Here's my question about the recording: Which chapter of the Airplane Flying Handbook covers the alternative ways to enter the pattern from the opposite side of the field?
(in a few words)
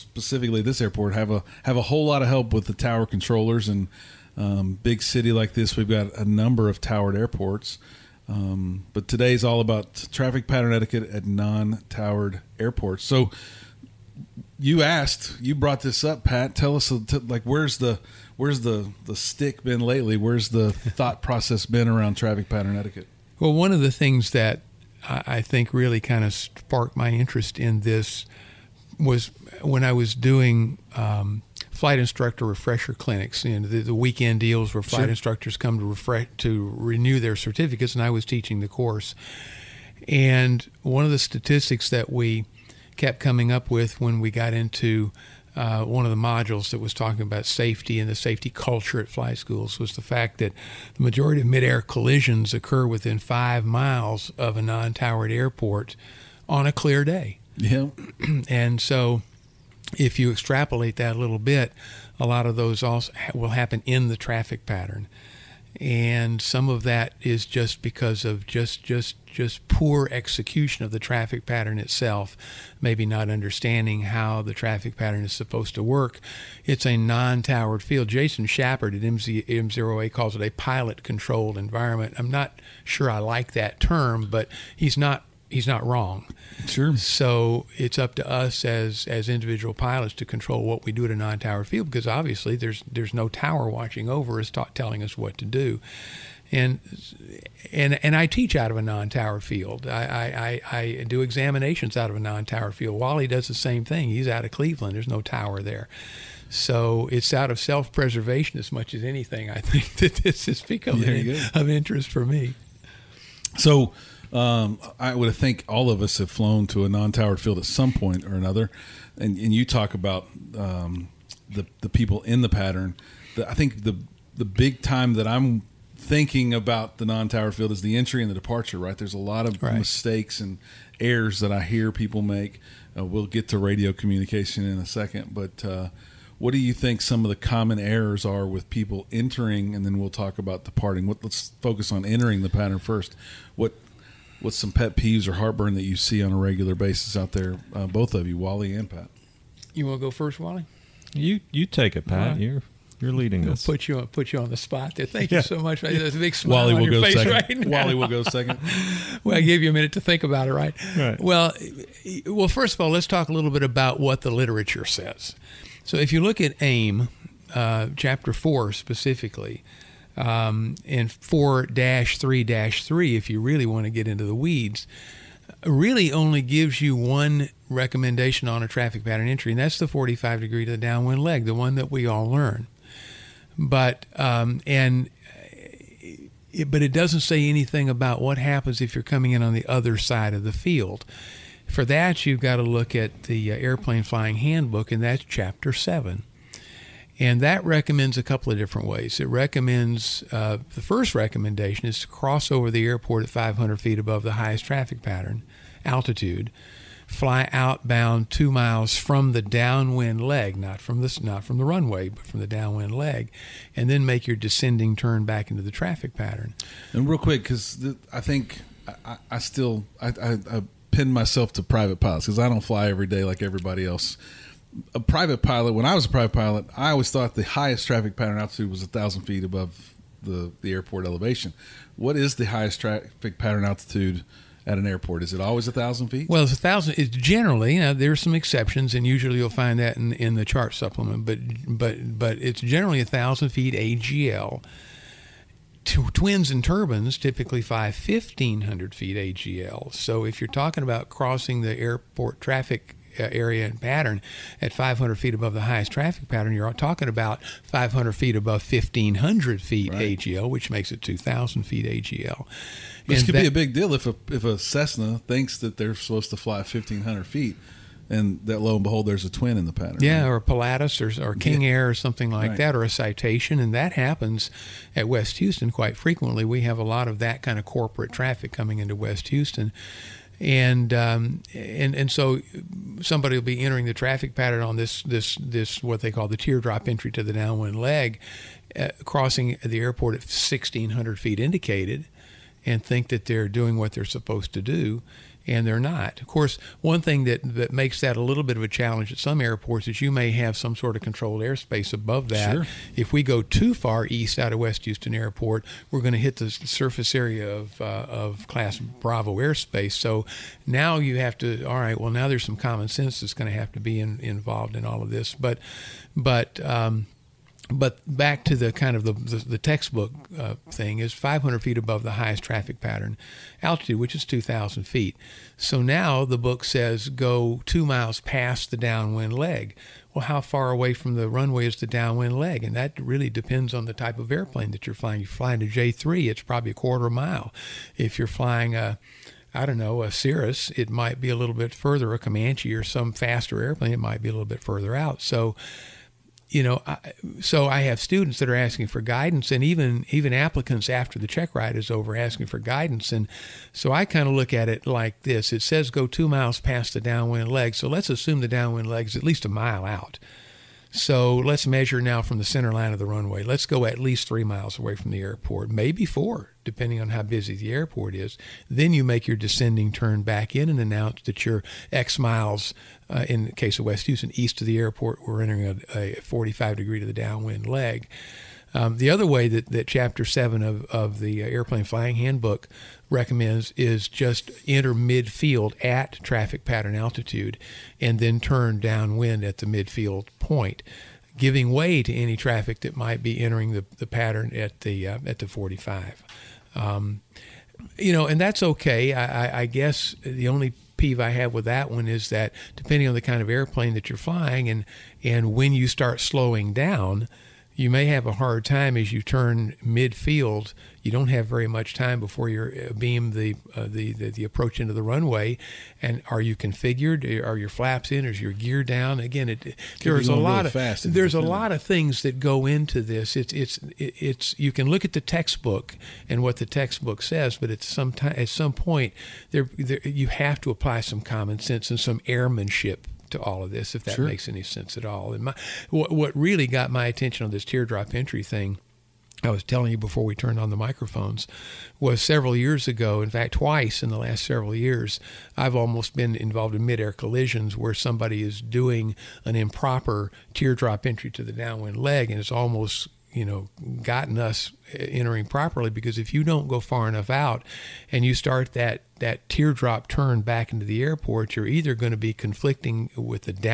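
Chapter 7.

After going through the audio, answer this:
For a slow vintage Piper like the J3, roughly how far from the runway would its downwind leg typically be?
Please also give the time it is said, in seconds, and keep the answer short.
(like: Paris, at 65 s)
a quarter mile, at 336 s.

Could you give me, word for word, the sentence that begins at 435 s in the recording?
And my, what, what really got my attention on this teardrop entry thing.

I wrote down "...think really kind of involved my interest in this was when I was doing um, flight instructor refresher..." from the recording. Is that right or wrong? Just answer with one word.
wrong.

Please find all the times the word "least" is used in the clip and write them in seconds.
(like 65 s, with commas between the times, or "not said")
359 s, 363 s.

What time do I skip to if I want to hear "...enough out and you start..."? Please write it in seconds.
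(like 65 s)
457 s.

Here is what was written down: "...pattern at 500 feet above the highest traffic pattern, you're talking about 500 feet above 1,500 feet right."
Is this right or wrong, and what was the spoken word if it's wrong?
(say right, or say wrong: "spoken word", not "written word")
right.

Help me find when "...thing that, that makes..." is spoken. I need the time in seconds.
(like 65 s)
297 s.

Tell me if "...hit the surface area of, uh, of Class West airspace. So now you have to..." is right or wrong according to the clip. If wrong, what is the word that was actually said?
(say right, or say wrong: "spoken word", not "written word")
wrong: "Bravo", not "West".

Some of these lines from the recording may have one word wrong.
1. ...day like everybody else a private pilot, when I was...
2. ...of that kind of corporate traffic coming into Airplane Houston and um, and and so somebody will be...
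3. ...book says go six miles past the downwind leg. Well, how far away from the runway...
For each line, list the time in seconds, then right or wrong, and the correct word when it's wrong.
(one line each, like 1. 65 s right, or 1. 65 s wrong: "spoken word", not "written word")
1. 223 s right
2. 277 s wrong: "West", not "Airplane"
3. 326 s wrong: "two", not "six".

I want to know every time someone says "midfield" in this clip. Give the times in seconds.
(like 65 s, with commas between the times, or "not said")
384 s, 389 s, 409 s.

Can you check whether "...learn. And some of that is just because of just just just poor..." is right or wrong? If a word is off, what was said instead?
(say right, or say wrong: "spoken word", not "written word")
wrong: "pattern", not "learn".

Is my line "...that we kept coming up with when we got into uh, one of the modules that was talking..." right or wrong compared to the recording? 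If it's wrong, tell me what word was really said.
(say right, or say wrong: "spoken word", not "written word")
right.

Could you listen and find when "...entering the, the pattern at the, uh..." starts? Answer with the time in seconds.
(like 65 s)
393 s.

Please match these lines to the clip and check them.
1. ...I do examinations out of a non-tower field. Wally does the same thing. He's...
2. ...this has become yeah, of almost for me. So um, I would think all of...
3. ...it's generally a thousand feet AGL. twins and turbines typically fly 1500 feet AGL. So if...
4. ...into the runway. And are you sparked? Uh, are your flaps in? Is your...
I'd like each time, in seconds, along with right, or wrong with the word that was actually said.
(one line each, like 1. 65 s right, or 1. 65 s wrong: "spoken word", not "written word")
1. 100 s right
2. 110 s wrong: "interest", not "almost"
3. 242 s right
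4. 414 s wrong: "configured", not "sparked".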